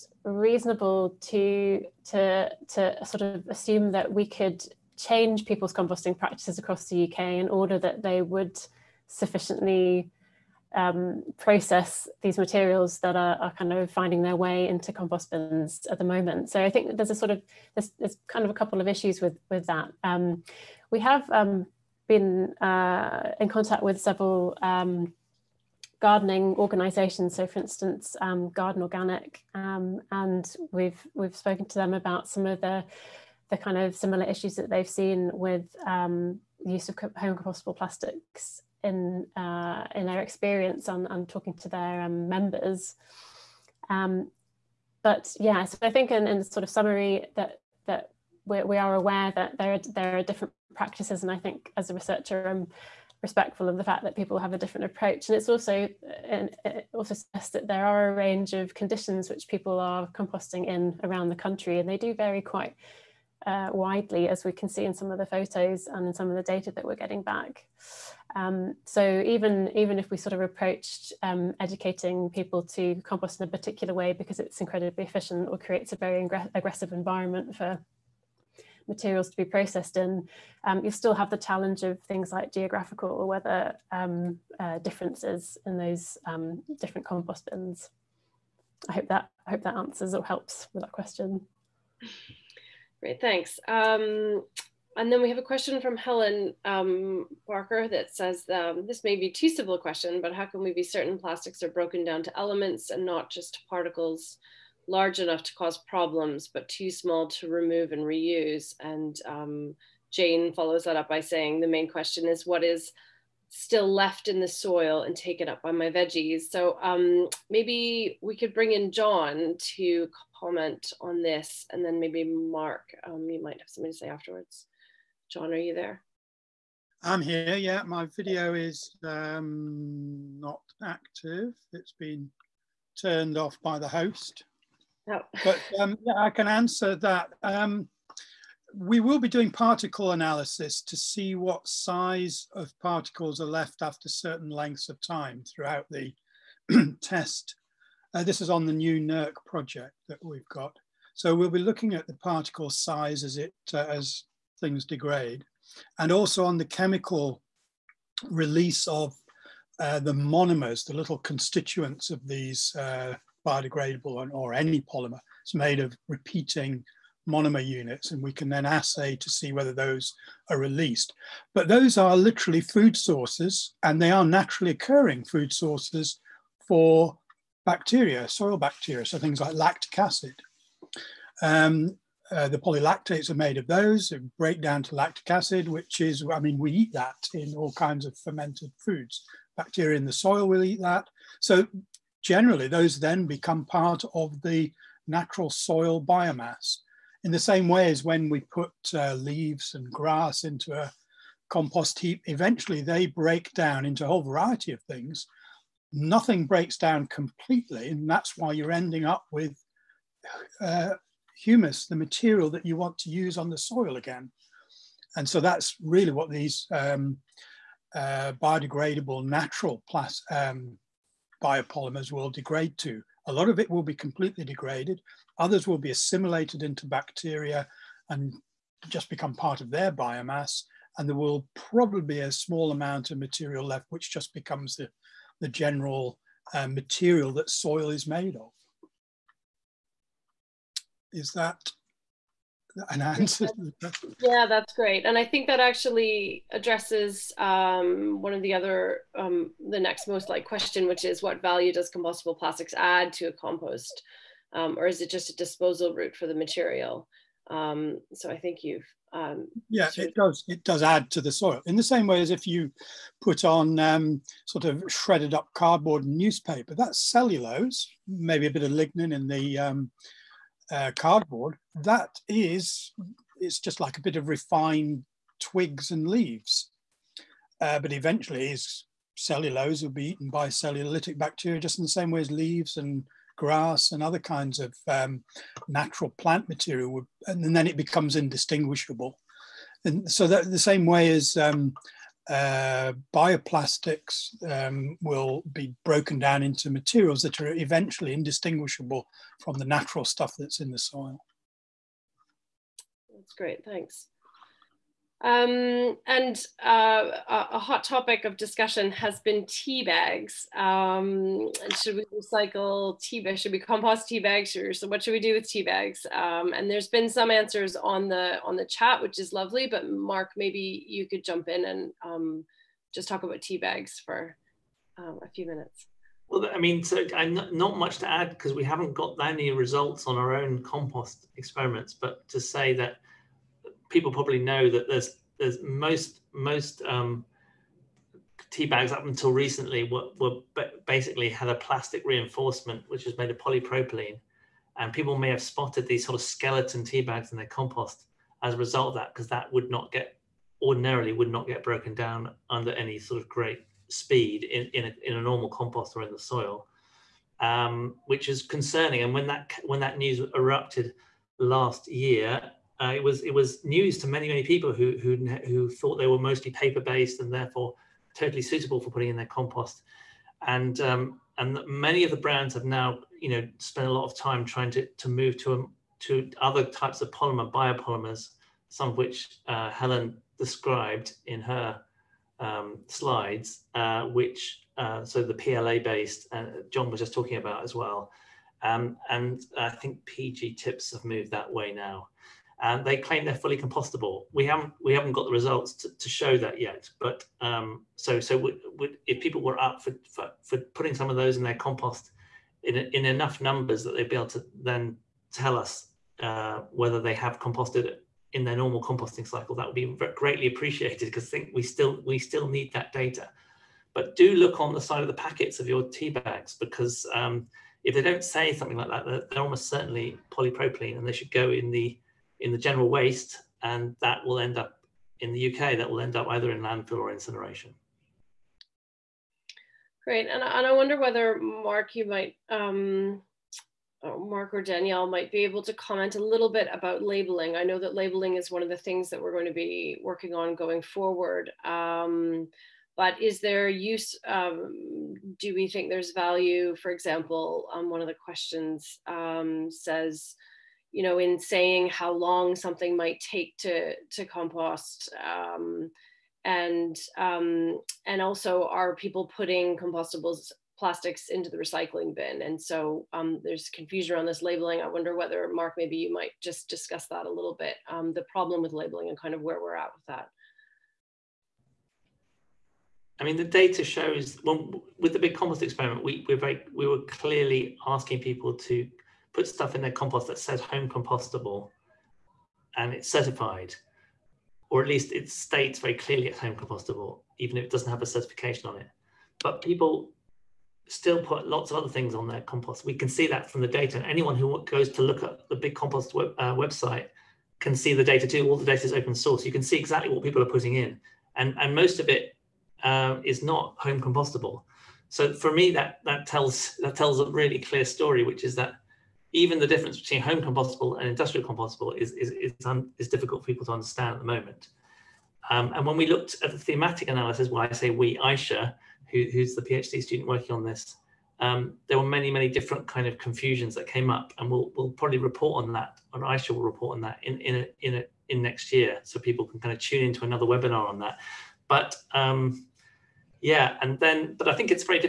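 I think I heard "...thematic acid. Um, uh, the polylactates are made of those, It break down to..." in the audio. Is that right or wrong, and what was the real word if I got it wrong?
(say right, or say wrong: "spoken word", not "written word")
wrong: "lactic", not "thematic".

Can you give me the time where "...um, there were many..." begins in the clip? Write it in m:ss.
8:41.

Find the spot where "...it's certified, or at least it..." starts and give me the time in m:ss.
8:02.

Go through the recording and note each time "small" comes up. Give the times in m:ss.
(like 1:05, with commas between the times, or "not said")
1:46, 3:52.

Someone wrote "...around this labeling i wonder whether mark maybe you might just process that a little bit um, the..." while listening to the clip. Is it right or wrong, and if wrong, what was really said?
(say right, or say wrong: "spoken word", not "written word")
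wrong: "discuss", not "process".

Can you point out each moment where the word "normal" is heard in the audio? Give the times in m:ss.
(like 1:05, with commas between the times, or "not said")
5:55, 6:48.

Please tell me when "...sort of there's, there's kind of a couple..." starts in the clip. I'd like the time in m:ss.
0:17.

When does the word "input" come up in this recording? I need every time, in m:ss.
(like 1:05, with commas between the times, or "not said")
not said.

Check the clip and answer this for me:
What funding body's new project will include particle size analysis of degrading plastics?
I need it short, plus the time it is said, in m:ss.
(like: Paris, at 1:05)
NERC, at 2:28.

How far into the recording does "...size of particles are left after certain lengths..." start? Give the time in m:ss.
2:21.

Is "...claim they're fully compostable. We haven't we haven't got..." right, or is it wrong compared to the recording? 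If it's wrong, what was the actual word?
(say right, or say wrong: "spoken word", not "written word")
right.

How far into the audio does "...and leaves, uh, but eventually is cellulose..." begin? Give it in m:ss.
4:35.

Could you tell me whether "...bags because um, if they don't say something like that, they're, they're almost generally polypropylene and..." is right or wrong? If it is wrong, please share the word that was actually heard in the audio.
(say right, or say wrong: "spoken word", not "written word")
wrong: "certainly", not "generally".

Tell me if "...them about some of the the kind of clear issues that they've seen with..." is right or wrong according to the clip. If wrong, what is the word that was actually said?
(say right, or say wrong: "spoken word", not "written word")
wrong: "similar", not "clear".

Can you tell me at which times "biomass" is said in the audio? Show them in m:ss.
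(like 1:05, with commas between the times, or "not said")
3:16, 3:49.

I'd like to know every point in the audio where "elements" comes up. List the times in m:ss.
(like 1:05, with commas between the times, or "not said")
1:42.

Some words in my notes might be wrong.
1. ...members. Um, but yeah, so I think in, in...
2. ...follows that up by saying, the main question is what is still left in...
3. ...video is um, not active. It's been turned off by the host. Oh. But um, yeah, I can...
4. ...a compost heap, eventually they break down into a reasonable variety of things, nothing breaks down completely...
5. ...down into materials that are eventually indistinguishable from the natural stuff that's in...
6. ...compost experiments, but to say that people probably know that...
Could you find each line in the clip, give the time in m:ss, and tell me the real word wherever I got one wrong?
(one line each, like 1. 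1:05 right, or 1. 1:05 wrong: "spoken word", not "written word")
1. 0:42 right
2. 1:50 right
3. 2:08 right
4. 3:20 wrong: "whole", not "reasonable"
5. 4:56 right
6. 5:30 right.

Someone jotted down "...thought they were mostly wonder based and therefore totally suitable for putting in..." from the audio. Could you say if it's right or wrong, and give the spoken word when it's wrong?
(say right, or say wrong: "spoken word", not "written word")
wrong: "paper", not "wonder".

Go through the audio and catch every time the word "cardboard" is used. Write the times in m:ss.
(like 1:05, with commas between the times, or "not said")
4:25, 4:30.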